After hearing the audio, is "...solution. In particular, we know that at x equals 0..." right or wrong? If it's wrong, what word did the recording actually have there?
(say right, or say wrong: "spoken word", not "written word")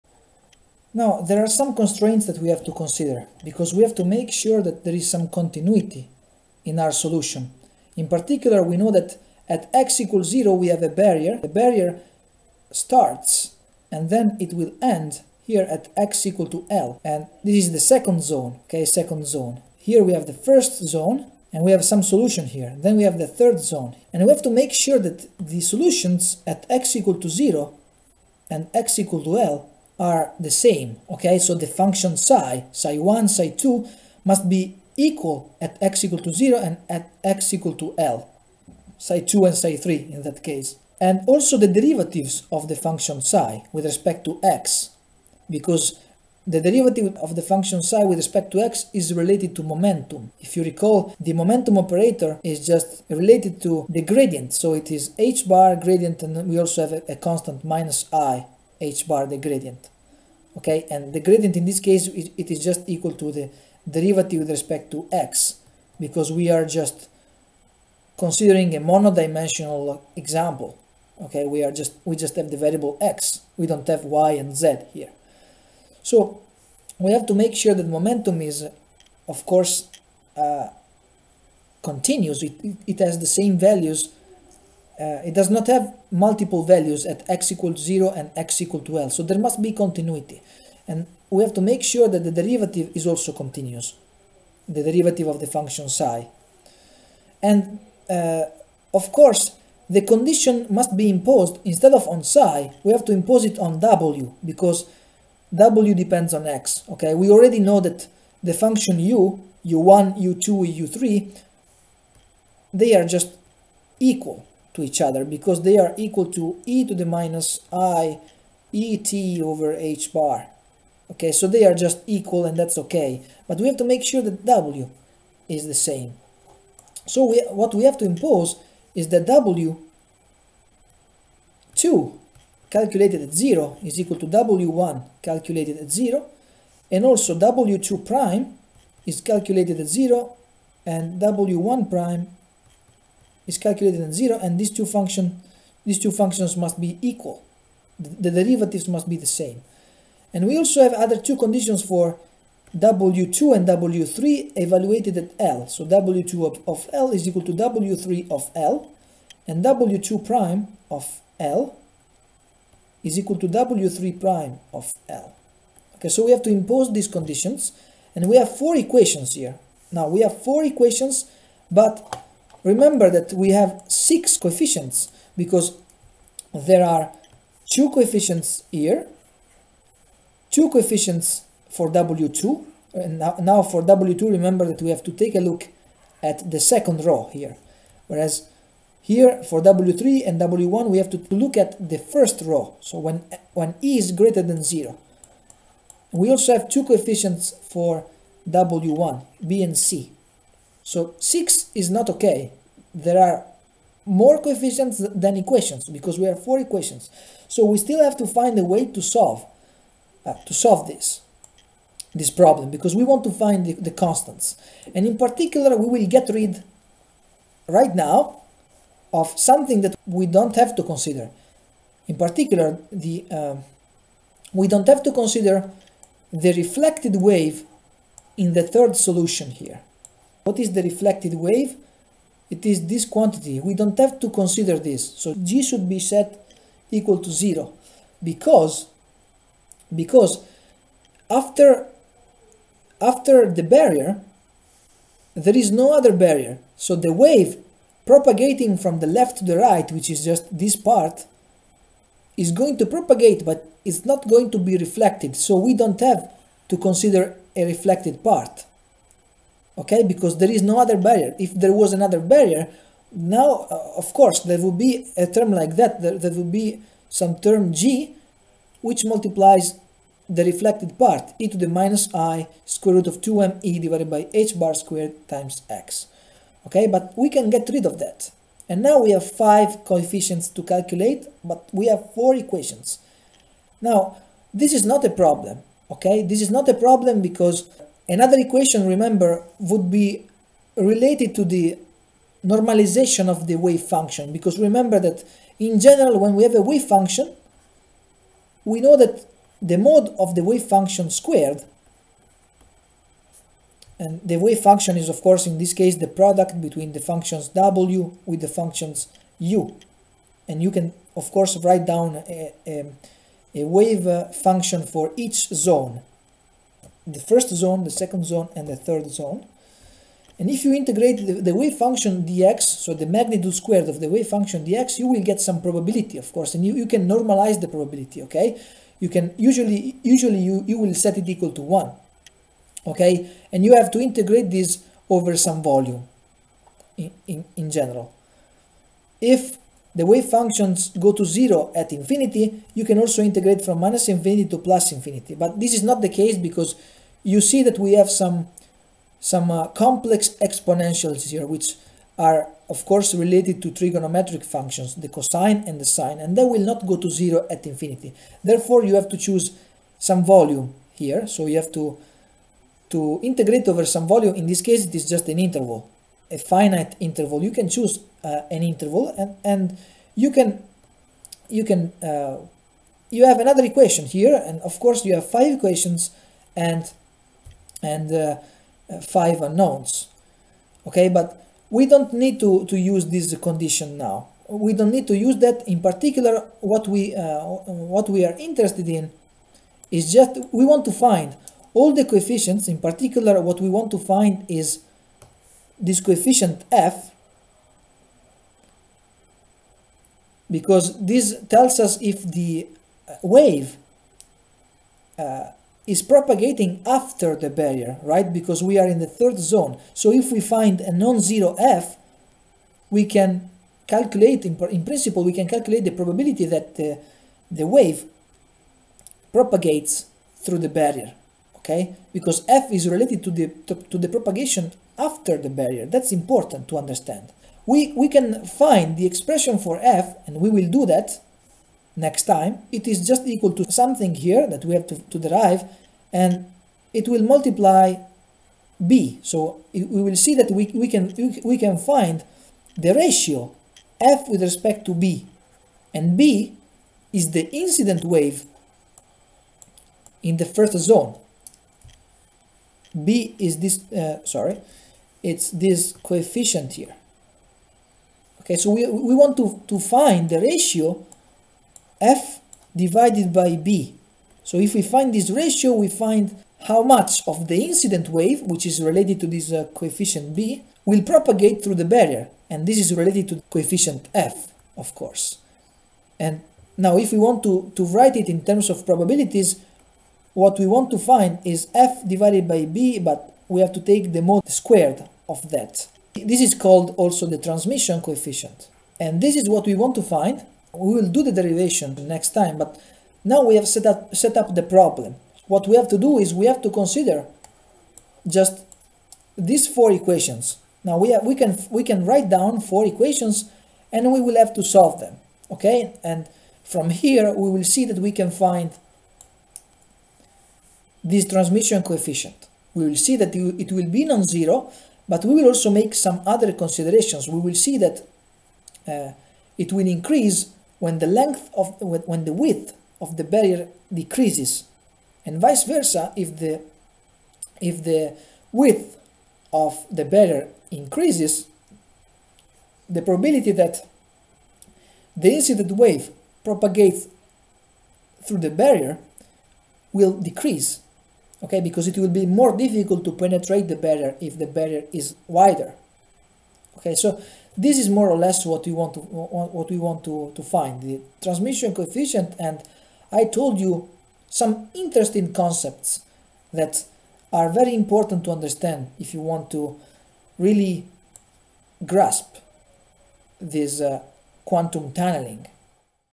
right.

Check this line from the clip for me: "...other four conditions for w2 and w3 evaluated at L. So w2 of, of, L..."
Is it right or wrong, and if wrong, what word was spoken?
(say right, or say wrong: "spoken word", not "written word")
wrong: "two", not "four".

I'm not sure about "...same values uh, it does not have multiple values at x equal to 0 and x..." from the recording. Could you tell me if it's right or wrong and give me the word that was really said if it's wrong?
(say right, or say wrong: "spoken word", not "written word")
right.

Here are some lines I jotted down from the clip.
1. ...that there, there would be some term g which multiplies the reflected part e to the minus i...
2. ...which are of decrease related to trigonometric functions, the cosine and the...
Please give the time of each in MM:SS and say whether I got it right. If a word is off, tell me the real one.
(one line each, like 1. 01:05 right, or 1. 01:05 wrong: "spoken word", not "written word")
1. 04:25 right
2. 05:51 wrong: "course", not "decrease".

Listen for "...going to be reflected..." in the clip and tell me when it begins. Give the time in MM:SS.
04:14.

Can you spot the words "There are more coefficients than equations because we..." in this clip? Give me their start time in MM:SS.
03:22.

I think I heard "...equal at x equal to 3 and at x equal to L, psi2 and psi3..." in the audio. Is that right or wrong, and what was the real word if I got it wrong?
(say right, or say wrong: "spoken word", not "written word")
wrong: "0", not "3".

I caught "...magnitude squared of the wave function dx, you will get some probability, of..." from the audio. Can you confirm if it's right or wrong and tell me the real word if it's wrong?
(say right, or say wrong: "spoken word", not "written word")
right.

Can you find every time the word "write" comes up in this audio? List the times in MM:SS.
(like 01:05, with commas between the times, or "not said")
05:11, 07:57, 08:22.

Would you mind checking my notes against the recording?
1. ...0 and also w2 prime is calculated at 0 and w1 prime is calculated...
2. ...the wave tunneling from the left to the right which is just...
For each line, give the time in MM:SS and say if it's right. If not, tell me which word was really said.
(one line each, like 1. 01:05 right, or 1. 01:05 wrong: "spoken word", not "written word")
1. 02:15 right
2. 04:06 wrong: "propagating", not "tunneling".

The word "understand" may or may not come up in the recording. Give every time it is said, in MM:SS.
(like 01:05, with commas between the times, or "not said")
07:06, 09:18.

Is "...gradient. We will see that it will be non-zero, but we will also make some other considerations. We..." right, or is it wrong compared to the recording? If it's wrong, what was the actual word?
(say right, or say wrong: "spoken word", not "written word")
wrong: "coefficient", not "gradient".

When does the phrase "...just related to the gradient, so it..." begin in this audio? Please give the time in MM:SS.
00:52.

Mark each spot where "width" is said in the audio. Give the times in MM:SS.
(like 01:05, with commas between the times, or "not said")
08:42, 08:48.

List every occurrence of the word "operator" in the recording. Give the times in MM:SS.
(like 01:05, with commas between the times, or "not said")
00:51.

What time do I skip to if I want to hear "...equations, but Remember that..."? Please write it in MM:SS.
02:50.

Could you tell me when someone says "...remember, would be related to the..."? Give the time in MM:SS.
04:48.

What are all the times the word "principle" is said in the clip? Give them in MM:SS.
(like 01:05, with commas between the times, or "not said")
06:54.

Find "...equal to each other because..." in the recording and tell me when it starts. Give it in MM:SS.
01:53.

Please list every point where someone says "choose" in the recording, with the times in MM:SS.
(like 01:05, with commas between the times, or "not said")
05:59, 06:07.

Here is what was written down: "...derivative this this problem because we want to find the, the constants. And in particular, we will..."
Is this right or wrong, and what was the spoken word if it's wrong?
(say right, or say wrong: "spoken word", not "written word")
wrong: "solve", not "derivative".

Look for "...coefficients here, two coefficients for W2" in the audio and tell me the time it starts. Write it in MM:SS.
02:57.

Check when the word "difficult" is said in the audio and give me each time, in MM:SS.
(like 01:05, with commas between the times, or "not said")
09:02.